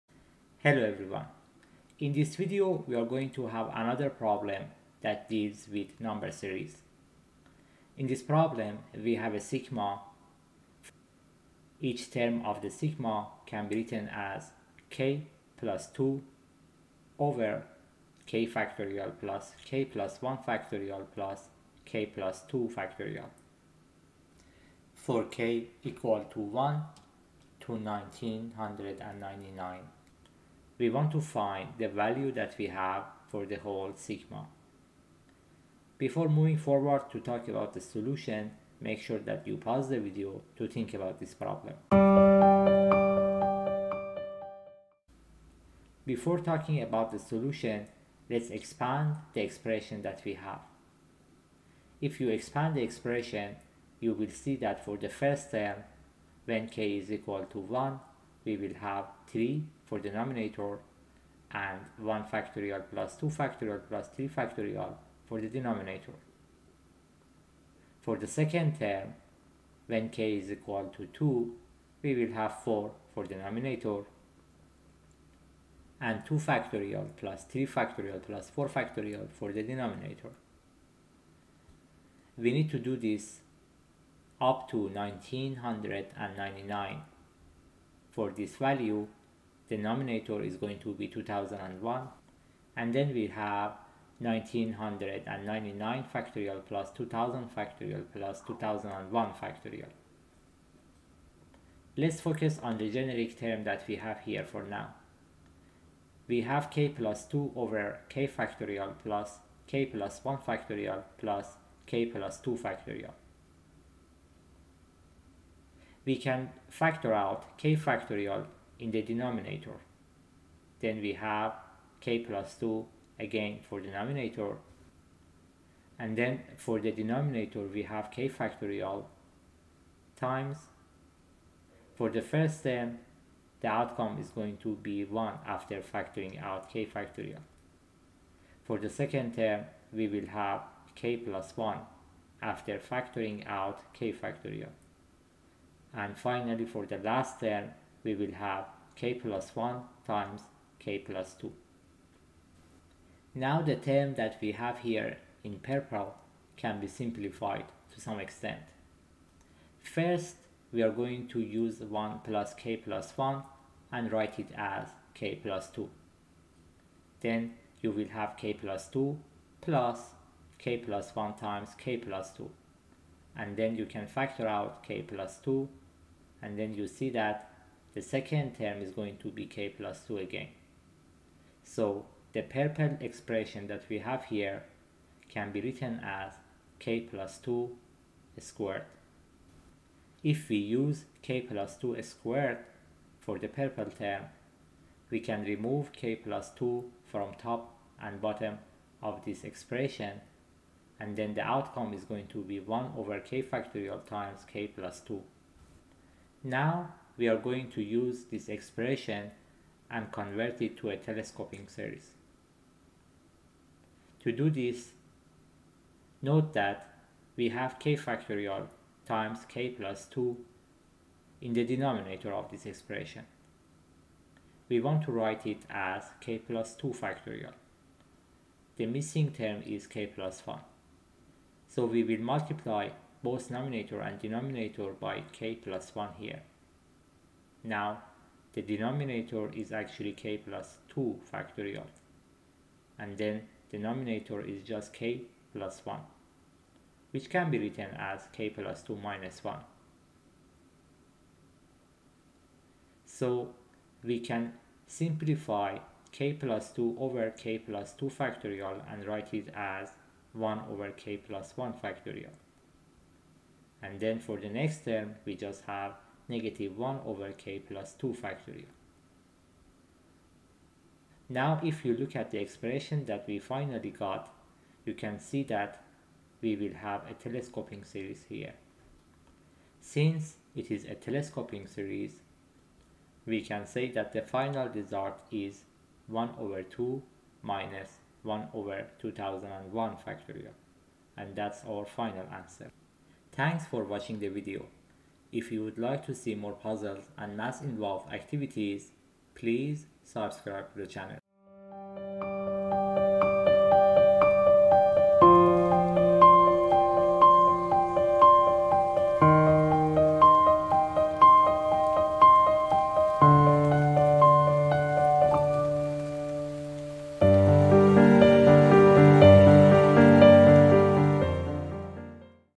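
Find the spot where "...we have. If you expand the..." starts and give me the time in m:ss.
0:50.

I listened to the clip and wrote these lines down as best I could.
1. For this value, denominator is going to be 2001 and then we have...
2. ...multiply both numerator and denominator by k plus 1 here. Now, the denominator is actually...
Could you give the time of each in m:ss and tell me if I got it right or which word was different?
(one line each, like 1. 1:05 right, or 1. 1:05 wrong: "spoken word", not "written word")
1. 1:28 right
2. 3:52 right.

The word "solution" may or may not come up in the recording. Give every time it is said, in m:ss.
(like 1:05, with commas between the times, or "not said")
0:37, 0:47.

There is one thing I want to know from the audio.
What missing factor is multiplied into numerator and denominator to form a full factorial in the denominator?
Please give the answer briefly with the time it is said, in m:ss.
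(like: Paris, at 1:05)
k plus 1, at 3:48.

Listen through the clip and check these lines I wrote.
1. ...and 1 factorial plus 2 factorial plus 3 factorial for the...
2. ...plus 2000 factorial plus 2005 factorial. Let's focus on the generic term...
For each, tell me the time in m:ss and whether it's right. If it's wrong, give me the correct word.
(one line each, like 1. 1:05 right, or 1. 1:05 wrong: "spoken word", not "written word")
1. 1:01 right
2. 1:36 wrong: "2001", not "2005".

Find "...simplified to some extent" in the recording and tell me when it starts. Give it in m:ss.
2:36.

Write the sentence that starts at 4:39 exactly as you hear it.
Since it is a telescoping series, we can say that the final result is 1 over 2 minus 1 over 2001 factorial.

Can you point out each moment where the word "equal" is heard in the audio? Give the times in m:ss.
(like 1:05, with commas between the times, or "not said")
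0:25, 0:57, 1:10.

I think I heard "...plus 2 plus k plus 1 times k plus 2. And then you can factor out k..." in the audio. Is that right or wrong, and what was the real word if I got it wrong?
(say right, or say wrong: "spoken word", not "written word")
right.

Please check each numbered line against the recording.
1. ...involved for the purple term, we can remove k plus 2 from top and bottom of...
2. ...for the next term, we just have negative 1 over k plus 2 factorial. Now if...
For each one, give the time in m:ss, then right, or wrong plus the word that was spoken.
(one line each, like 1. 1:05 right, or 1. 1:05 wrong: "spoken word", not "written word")
1. 3:12 wrong: "squared", not "involved"
2. 4:24 right.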